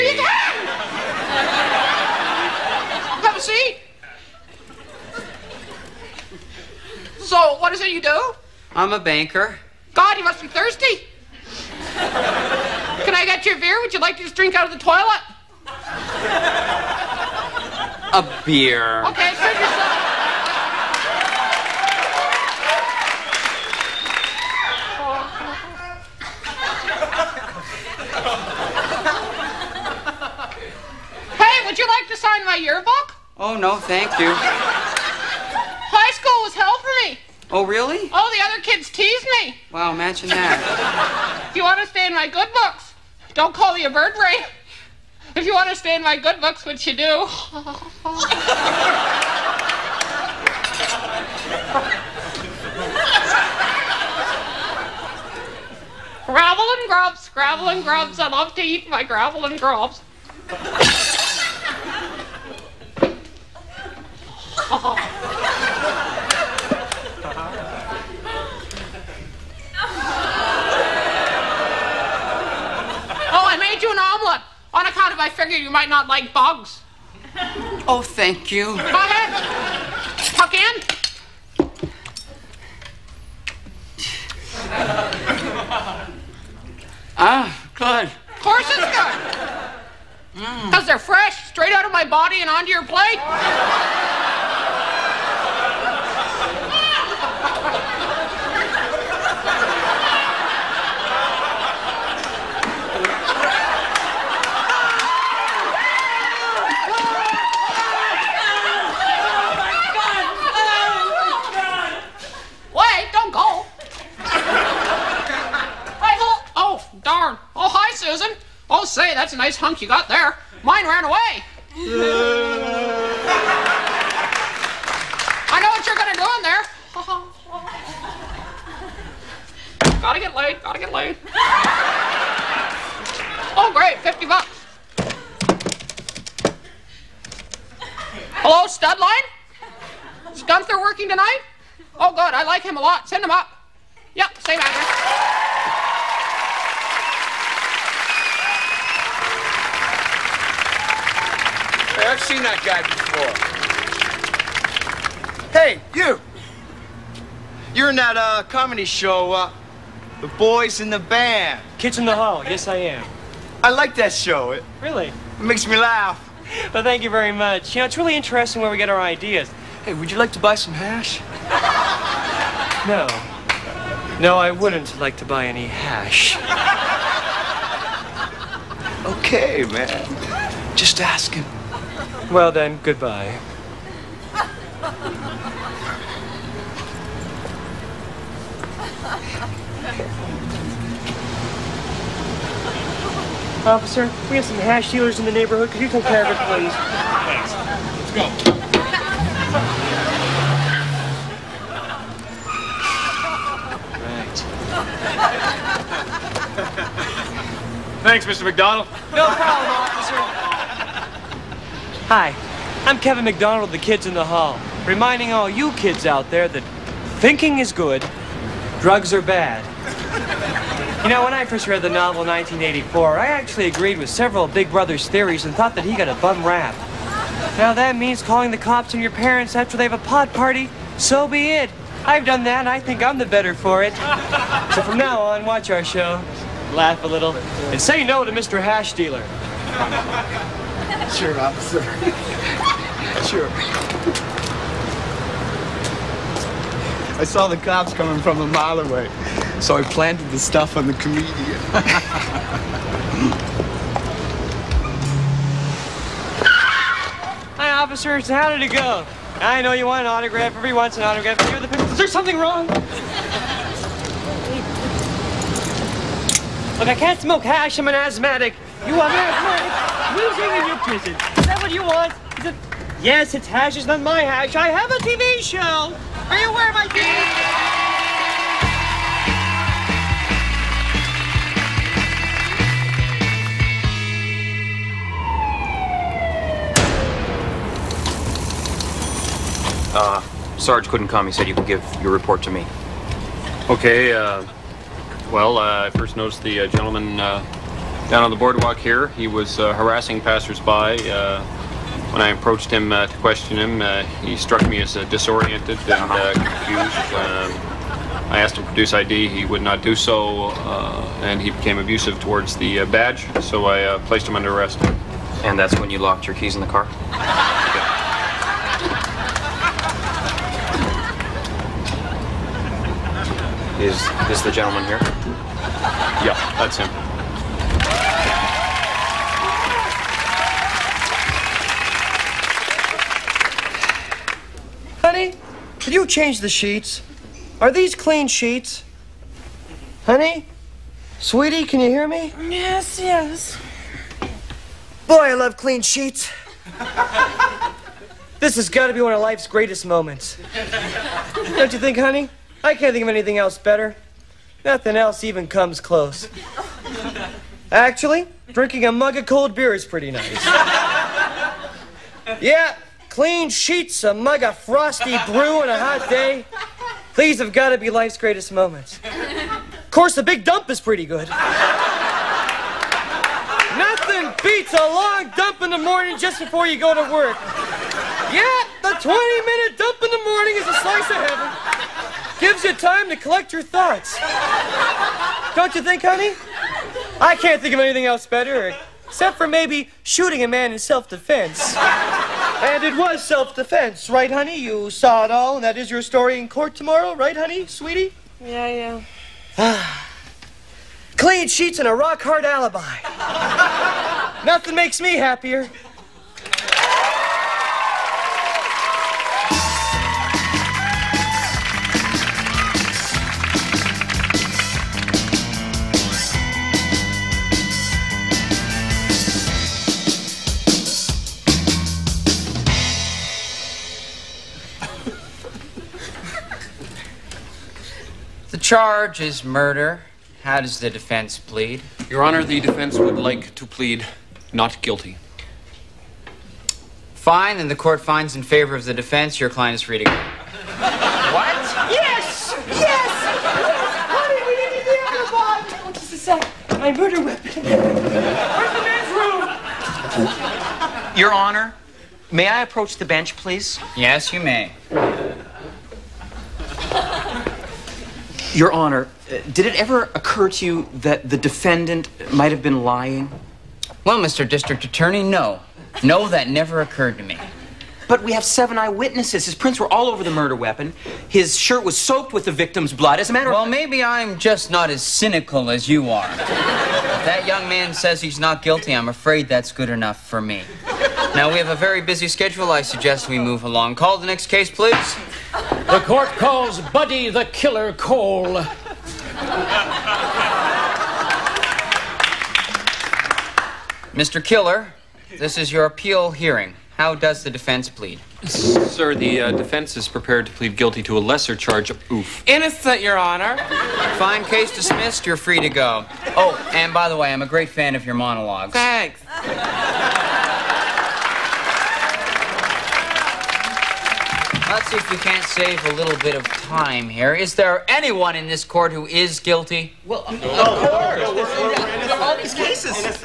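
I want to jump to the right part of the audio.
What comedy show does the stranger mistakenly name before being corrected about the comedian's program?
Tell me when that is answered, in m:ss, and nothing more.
2:40.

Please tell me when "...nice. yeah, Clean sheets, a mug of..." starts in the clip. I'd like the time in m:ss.
6:00.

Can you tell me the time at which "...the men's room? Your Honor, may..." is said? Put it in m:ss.
7:28.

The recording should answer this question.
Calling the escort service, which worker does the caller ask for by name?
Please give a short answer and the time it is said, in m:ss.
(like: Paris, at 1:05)
Gunther, at 2:20.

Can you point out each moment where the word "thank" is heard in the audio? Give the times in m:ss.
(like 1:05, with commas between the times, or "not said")
0:33, 1:18, 2:46, 3:17, 3:28, 8:28.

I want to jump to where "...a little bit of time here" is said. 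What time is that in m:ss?
8:35.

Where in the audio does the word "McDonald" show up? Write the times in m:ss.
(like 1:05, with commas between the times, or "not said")
3:28, 3:33.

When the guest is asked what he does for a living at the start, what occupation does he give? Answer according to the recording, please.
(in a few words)
Banker.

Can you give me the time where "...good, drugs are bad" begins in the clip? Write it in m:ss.
3:37.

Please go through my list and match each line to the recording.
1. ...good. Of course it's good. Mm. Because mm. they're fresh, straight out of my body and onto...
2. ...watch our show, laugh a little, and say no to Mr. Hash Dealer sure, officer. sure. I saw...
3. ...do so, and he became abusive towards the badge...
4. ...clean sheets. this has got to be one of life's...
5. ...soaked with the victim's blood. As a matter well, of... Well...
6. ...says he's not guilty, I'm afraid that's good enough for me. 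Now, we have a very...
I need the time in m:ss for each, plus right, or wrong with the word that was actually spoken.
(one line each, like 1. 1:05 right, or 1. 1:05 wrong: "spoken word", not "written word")
1. 1:27 right
2. 3:55 right
3. 5:09 right
4. 5:45 right
5. 7:51 right
6. 7:57 right.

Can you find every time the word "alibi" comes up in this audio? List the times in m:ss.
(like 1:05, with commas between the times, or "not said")
6:42.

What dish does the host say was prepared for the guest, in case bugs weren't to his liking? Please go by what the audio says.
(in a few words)
Omelet.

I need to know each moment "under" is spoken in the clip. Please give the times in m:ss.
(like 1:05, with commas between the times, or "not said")
5:14.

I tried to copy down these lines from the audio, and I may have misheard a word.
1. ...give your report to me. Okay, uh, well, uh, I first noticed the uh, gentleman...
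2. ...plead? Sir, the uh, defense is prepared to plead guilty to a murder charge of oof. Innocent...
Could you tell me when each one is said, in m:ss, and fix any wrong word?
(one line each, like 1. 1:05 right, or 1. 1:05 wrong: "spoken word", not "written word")
1. 4:51 right
2. 8:17 wrong: "lesser", not "murder".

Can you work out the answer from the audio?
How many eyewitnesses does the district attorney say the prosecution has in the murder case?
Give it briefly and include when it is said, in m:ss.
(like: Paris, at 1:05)
7, at 7:48.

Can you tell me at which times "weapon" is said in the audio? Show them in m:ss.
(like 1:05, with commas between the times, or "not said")
7:27, 7:50.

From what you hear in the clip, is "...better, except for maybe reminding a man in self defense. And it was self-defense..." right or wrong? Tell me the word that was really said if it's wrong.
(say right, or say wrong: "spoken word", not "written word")
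wrong: "shooting", not "reminding".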